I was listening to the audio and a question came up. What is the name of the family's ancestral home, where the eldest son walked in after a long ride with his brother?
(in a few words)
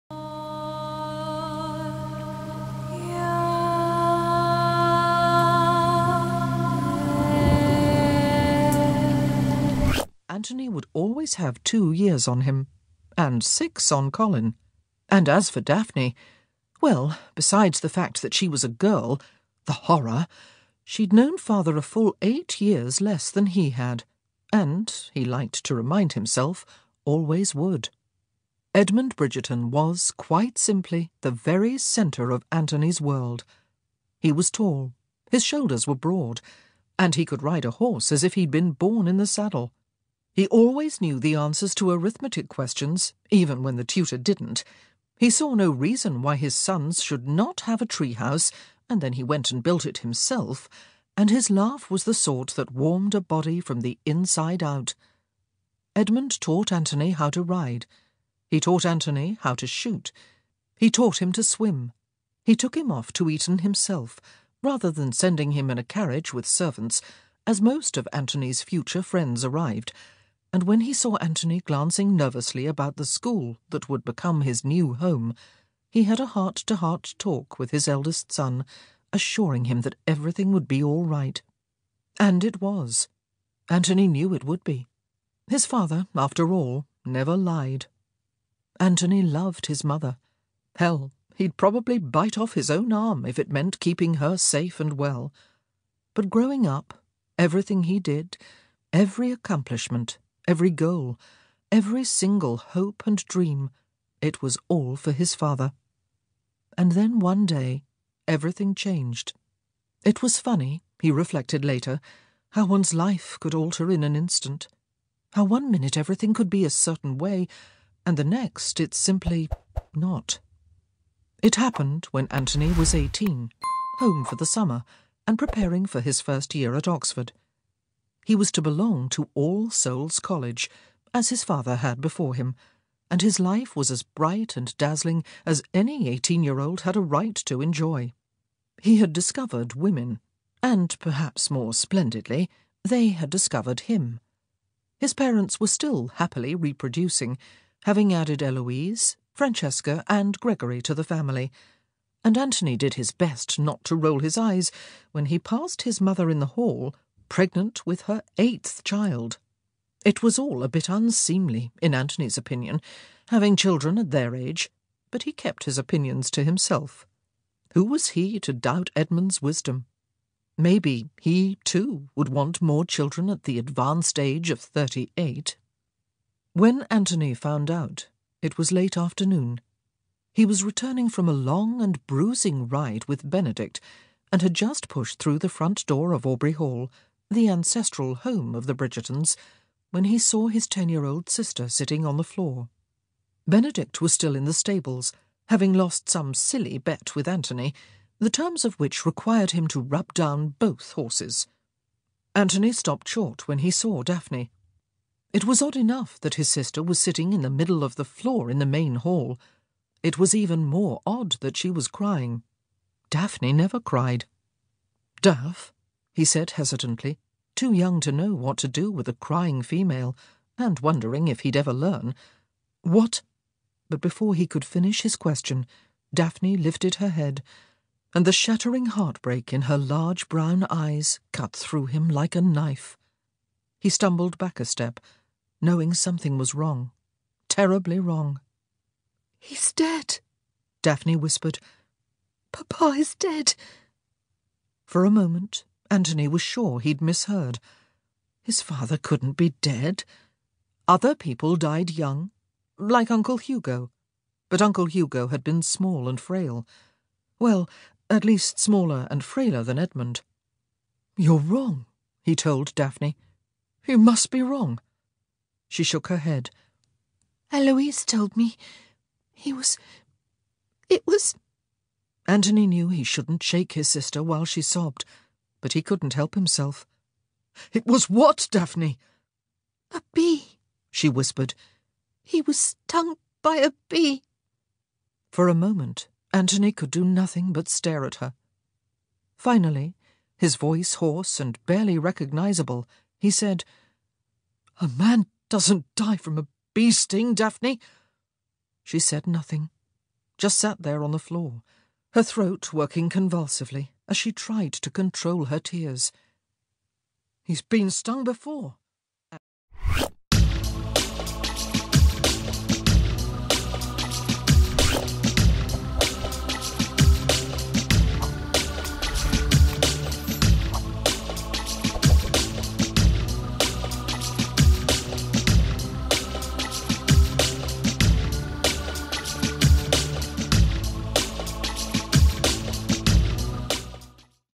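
Aubrey Hall.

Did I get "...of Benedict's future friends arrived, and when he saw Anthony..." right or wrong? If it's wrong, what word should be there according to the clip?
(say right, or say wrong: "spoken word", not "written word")
wrong: "Anthony", not "Benedict".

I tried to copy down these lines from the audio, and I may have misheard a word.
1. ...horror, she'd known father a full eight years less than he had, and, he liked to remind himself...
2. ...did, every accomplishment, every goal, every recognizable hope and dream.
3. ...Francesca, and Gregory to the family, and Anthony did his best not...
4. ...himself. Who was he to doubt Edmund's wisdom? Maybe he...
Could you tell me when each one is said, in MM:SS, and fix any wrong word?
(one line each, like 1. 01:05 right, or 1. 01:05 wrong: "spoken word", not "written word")
1. 00:19 right
2. 01:37 wrong: "single", not "recognizable"
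3. 02:29 right
4. 02:46 right.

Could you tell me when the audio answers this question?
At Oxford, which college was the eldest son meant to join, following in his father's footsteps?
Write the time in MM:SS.
02:09.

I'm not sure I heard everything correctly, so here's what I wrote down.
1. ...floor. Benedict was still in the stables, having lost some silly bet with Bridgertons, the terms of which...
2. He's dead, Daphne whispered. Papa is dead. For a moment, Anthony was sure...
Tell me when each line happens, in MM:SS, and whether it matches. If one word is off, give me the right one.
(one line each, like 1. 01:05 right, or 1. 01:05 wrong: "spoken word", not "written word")
1. 03:12 wrong: "Anthony", not "Bridgertons"
2. 03:59 right.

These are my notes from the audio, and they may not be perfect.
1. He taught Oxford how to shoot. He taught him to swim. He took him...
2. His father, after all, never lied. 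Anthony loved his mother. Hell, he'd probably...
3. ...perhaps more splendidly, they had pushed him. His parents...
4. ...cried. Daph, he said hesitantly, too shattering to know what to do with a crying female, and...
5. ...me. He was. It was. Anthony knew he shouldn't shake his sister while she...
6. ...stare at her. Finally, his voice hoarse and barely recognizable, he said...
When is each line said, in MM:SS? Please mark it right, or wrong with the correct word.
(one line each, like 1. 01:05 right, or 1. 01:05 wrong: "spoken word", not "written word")
1. 00:58 wrong: "Anthony", not "Oxford"
2. 01:25 right
3. 02:20 wrong: "discovered", not "pushed"
4. 03:33 wrong: "young", not "shattering"
5. 04:28 right
6. 04:47 right.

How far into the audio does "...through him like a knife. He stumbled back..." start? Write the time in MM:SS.
03:51.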